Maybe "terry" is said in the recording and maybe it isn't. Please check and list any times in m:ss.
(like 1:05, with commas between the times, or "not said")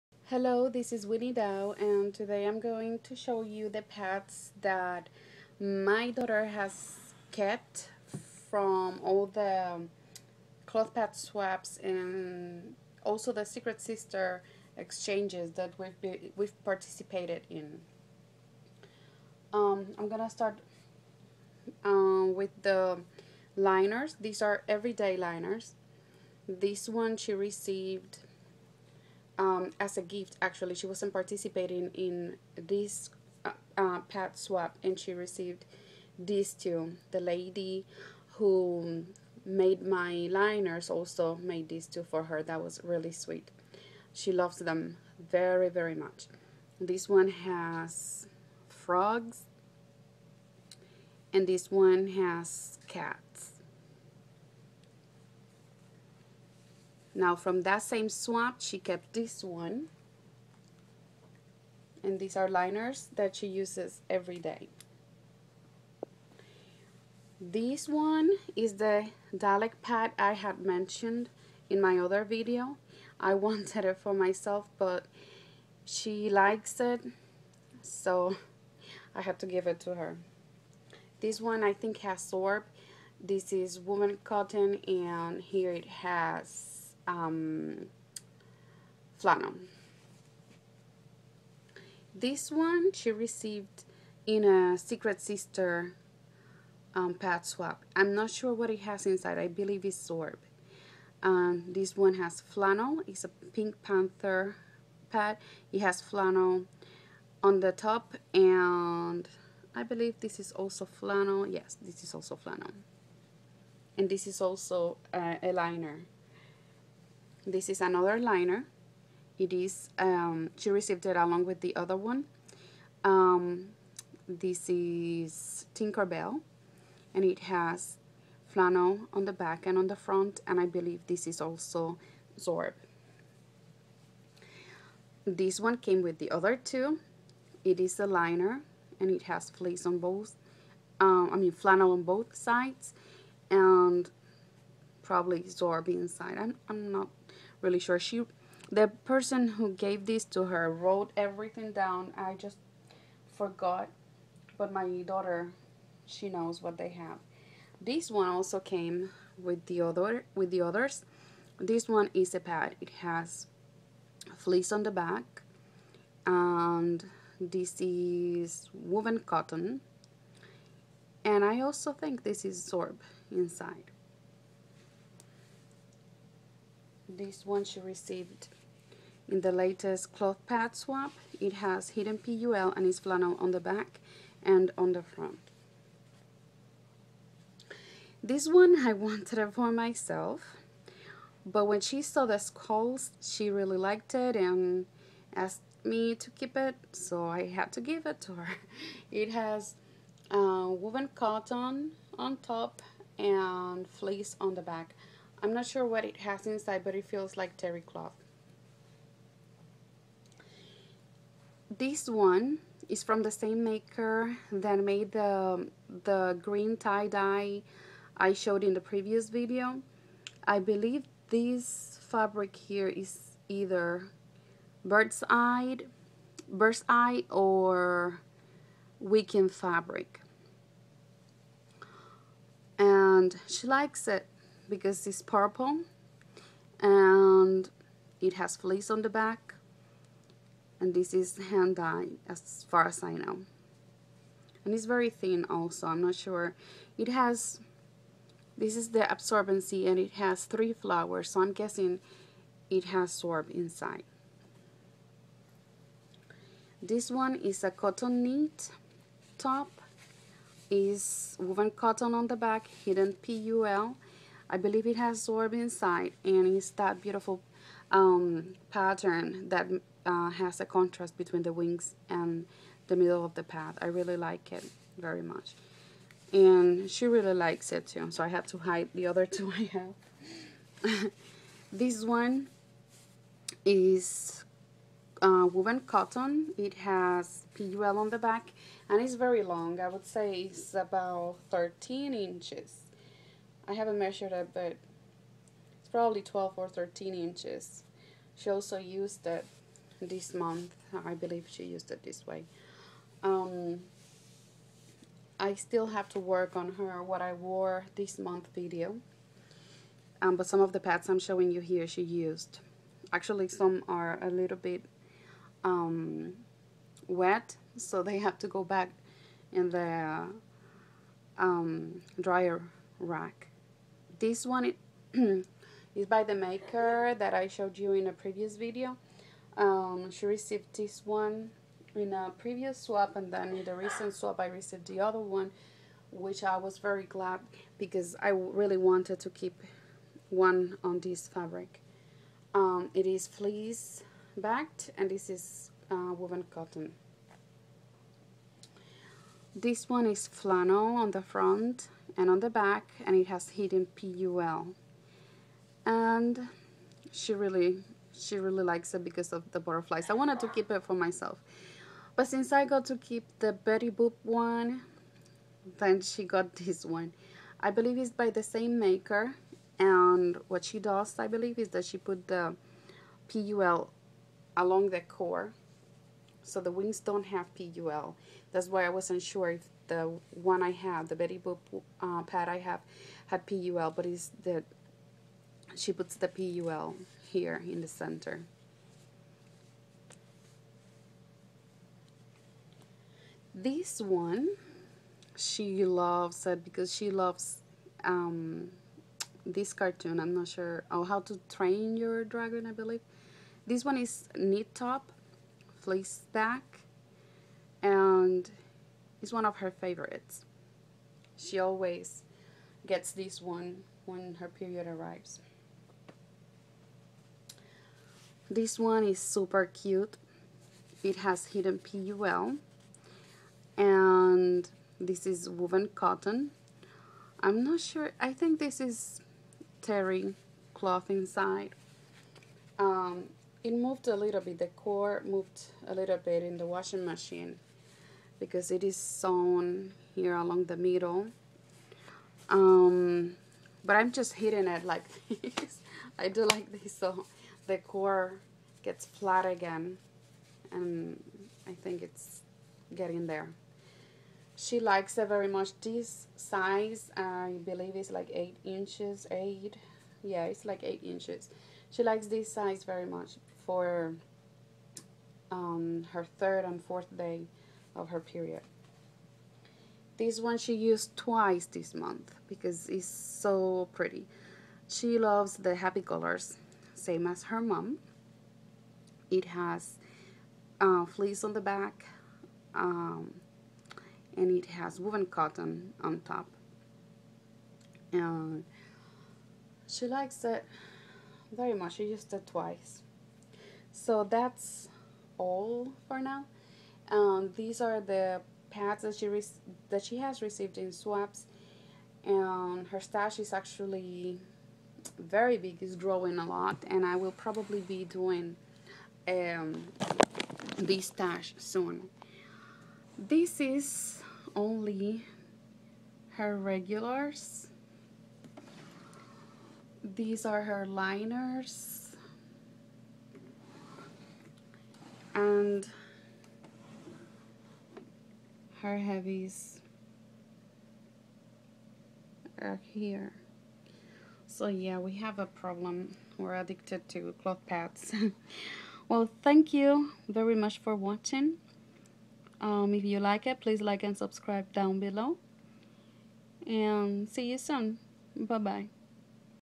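3:27, 7:09.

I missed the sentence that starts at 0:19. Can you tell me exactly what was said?
Um, I'm gonna start um, with the liners.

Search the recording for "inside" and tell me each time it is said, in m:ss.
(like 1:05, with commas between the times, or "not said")
1:39, 2:25, 2:53, 3:26, 4:13, 4:25, 7:11.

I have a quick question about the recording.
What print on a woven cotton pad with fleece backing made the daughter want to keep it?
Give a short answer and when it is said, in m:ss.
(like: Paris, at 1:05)
Skulls, at 3:12.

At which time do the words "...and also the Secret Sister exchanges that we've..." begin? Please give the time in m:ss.
0:11.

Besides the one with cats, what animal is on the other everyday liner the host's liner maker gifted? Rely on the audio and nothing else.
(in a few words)
Frogs.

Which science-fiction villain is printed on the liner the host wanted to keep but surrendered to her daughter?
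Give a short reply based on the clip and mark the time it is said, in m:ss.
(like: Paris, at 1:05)
Dalek, at 1:09.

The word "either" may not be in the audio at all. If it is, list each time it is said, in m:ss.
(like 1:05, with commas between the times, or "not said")
3:43.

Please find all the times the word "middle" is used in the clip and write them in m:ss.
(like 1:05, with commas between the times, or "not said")
4:32, 7:20.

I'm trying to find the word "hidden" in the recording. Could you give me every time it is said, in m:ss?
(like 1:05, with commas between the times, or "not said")
3:01, 4:22, 5:53, 7:01.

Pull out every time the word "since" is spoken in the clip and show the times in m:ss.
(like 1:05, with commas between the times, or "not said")
6:02.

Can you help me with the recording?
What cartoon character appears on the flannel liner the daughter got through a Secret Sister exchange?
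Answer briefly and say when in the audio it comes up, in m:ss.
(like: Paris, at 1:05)
Pink Panther, at 1:43.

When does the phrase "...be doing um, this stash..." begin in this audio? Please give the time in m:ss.
8:27.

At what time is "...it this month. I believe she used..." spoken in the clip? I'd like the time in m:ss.
4:59.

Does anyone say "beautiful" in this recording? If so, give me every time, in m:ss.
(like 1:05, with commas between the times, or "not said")
4:27.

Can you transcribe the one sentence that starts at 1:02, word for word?
And these are liners that she uses every day.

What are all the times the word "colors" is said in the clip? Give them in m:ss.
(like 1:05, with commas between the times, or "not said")
7:56.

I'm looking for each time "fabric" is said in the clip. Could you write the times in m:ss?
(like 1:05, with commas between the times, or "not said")
3:42, 3:49, 5:41.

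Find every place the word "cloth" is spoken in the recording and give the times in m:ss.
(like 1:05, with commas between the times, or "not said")
0:10, 3:00, 3:27, 7:10, 8:57.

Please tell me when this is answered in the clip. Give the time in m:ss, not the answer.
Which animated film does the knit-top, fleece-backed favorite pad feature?
6:41.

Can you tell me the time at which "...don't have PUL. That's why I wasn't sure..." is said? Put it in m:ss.
6:16.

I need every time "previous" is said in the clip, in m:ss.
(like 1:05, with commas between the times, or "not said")
3:38, 5:28, 5:32.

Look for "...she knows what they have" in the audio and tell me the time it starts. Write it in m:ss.
2:36.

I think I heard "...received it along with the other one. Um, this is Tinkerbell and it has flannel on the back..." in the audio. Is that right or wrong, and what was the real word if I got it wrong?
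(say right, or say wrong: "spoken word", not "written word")
right.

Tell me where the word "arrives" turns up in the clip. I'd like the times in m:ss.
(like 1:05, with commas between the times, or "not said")
6:54.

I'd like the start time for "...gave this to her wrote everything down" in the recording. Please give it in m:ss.
2:29.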